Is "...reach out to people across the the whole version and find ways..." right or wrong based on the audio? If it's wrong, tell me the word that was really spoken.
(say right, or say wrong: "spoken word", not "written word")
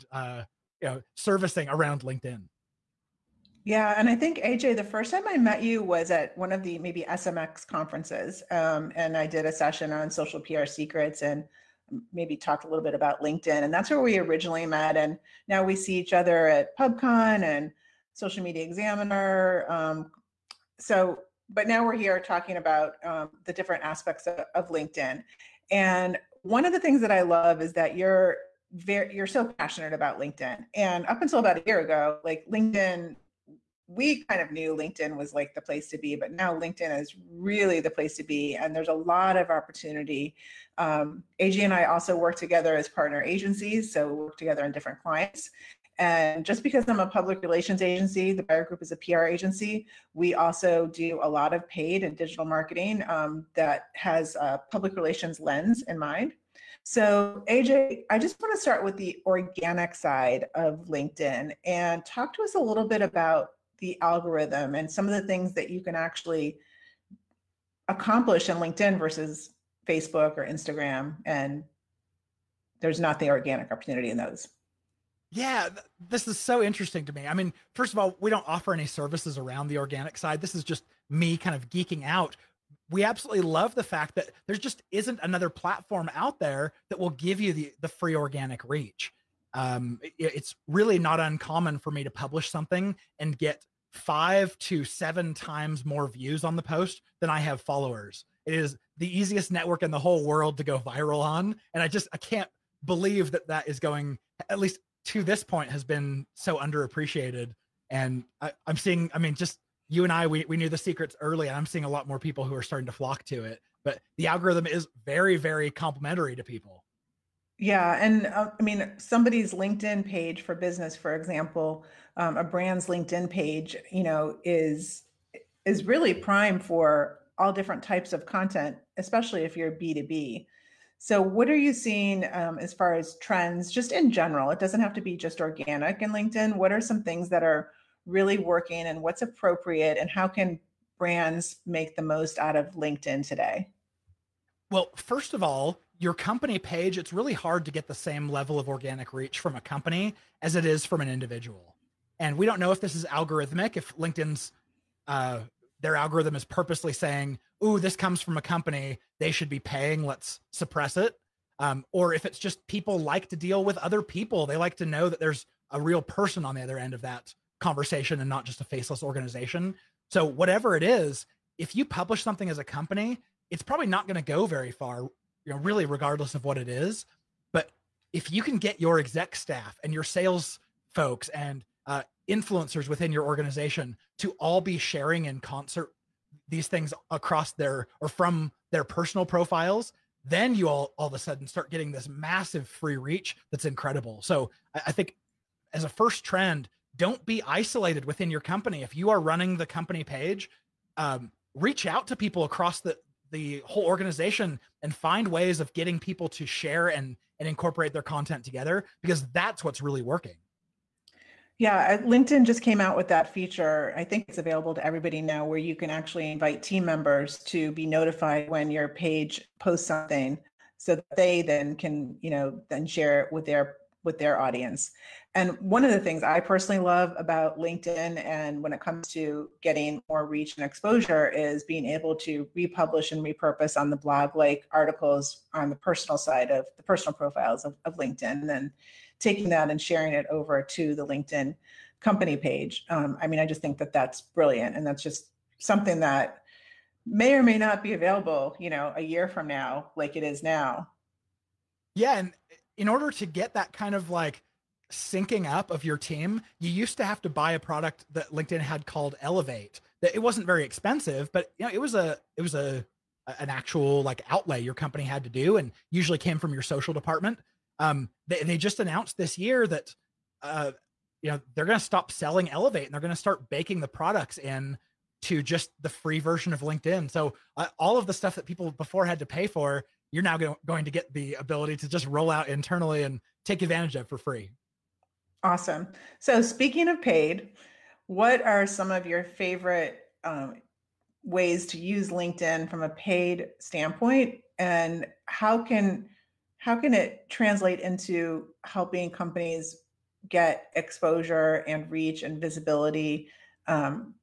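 wrong: "organization", not "version".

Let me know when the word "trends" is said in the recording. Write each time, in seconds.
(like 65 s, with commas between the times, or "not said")
133 s, 196 s.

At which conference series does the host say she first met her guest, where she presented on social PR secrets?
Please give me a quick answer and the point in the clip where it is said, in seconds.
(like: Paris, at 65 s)
SMX, at 7 s.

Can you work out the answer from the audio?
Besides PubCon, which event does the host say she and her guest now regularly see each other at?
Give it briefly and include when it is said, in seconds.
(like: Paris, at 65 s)
Social Media Examiner, at 18 s.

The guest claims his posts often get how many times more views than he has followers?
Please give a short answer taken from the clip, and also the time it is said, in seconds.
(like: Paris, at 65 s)
5 to 7, at 93 s.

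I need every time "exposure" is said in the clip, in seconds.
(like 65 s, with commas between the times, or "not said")
230 s, 300 s.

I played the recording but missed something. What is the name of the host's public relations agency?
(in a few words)
the Buyer Group.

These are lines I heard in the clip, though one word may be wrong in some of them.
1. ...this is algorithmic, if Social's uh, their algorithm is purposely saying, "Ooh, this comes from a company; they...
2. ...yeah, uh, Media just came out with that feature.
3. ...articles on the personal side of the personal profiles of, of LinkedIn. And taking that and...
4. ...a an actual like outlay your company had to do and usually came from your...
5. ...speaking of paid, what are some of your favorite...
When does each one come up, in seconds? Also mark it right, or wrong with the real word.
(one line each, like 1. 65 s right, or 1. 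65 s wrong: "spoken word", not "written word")
1. 152 s wrong: "LinkedIn", not "Social"
2. 211 s wrong: "LinkedIn", not "Media"
3. 234 s right
4. 262 s right
5. 286 s right.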